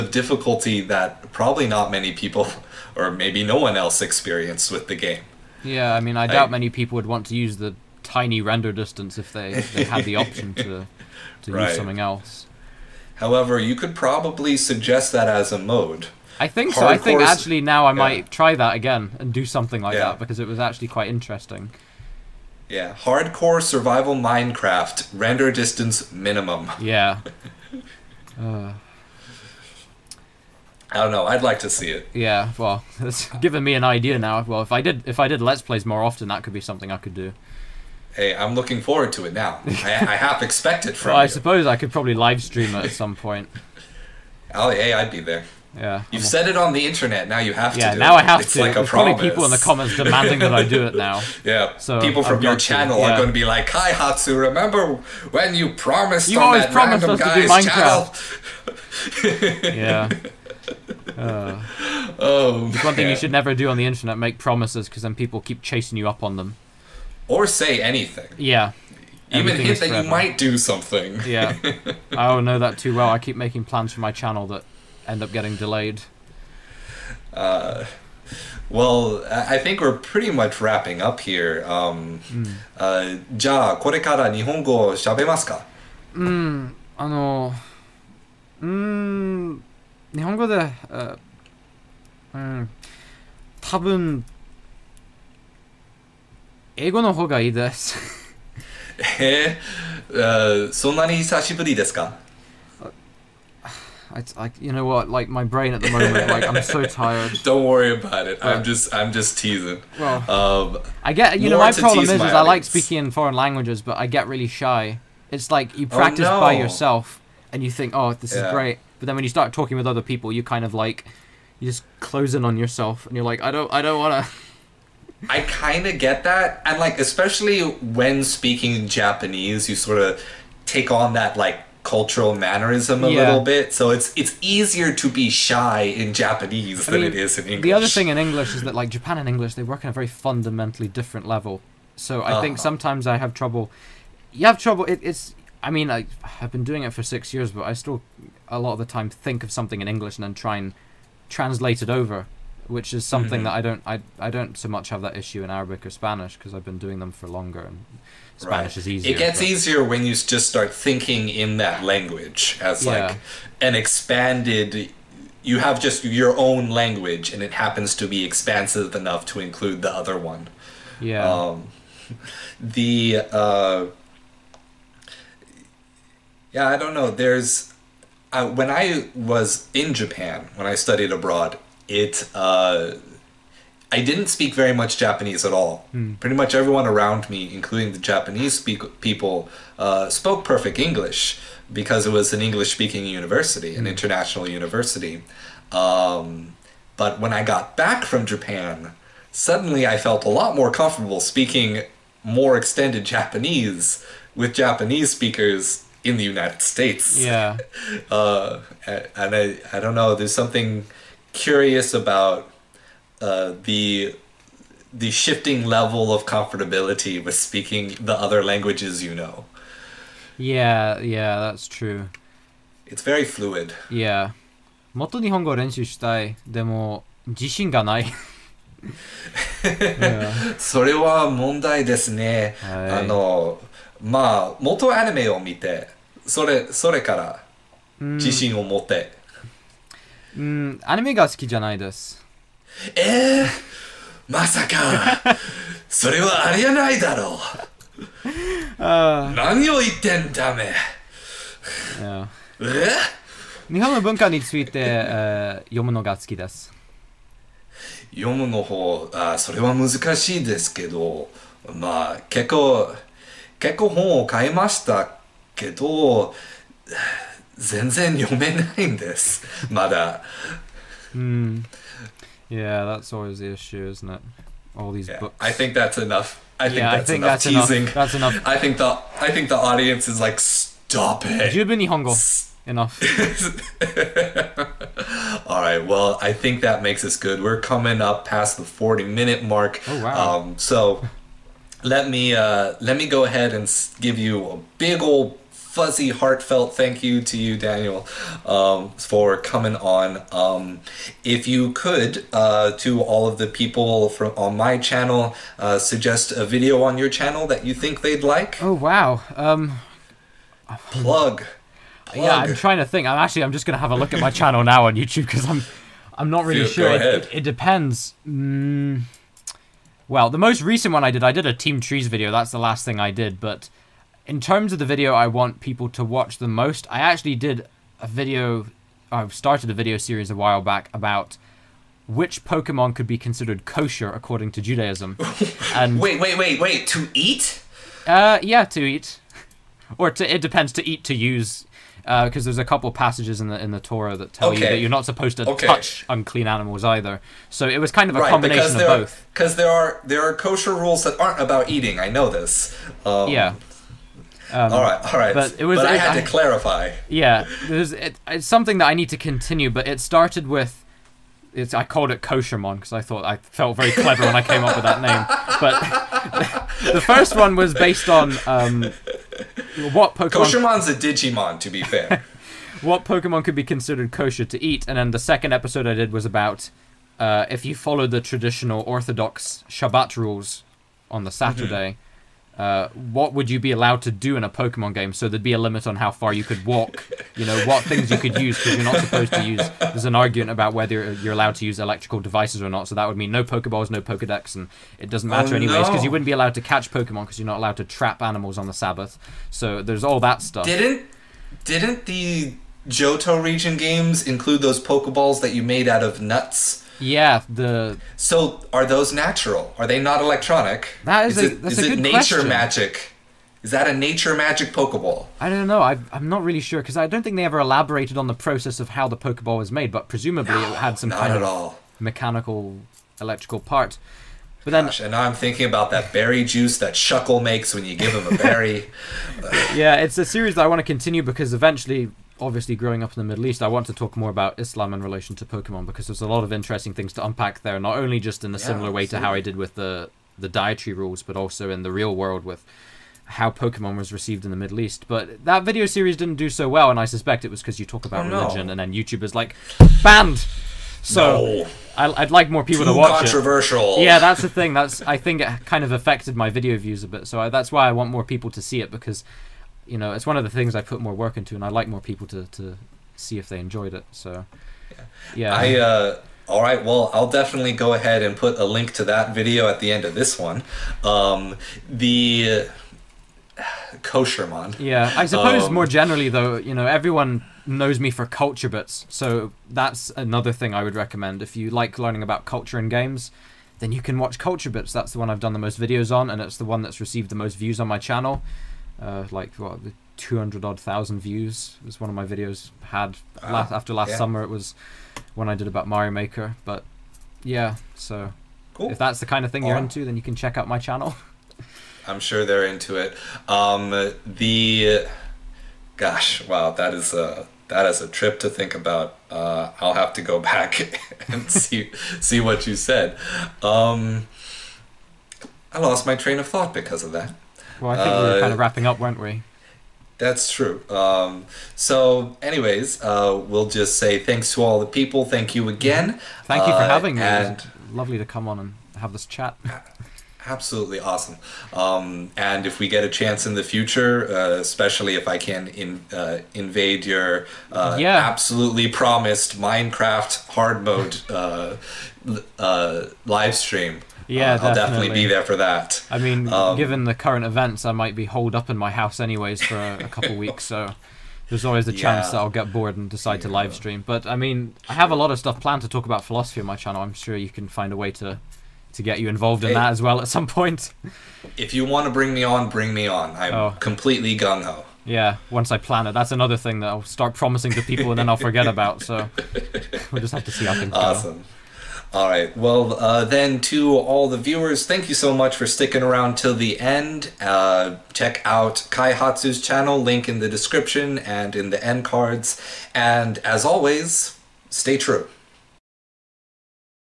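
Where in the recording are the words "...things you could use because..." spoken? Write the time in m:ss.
6:27.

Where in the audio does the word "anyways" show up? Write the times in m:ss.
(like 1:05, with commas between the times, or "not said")
6:35, 8:42, 9:09.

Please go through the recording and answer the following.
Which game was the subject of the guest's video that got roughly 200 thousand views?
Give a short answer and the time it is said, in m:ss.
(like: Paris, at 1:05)
Mario Maker, at 8:15.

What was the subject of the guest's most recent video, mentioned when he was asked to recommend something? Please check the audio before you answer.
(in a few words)
Team Trees.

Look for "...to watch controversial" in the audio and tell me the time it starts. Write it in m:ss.
7:32.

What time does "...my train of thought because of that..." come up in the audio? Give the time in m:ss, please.
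8:36.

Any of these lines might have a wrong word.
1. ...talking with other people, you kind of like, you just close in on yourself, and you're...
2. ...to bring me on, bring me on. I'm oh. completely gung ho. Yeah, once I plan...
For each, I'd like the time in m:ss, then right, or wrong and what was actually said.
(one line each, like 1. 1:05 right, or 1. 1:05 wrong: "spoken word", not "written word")
1. 1:59 right
2. 9:22 right.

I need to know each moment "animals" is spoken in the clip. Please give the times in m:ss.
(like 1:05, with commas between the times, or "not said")
5:46, 6:38.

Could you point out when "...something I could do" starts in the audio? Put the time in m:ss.
0:36.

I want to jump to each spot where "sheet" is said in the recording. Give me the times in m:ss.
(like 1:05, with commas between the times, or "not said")
not said.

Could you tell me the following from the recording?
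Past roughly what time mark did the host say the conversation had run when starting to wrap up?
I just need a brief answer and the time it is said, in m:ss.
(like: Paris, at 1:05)
40 minutes, at 4:48.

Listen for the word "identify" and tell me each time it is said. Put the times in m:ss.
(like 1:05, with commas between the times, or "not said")
not said.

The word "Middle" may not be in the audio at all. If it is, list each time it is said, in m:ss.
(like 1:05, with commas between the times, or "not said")
7:13, 7:24.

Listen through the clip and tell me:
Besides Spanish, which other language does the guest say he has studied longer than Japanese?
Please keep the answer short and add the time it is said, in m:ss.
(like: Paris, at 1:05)
Arabic, at 2:35.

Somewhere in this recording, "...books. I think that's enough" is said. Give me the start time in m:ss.
4:35.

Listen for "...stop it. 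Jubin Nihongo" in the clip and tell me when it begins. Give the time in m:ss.
4:40.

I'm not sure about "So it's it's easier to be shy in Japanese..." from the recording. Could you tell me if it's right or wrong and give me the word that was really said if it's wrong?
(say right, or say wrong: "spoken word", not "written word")
right.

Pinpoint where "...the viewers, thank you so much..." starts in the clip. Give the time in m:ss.
9:34.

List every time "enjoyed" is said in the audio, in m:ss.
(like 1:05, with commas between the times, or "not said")
7:43.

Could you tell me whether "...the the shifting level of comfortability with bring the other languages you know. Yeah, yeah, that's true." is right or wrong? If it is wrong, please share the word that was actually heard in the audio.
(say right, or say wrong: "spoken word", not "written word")
wrong: "speaking", not "bring".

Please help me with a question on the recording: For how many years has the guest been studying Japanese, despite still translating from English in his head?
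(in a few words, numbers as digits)
6.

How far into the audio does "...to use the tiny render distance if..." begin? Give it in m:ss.
0:07.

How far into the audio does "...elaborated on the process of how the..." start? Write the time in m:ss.
6:57.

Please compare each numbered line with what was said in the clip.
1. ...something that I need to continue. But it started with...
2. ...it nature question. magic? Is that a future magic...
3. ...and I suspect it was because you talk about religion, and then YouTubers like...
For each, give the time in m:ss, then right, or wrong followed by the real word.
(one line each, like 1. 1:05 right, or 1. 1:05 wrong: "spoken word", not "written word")
1. 5:58 right
2. 6:51 wrong: "nature", not "future"
3. 7:26 right.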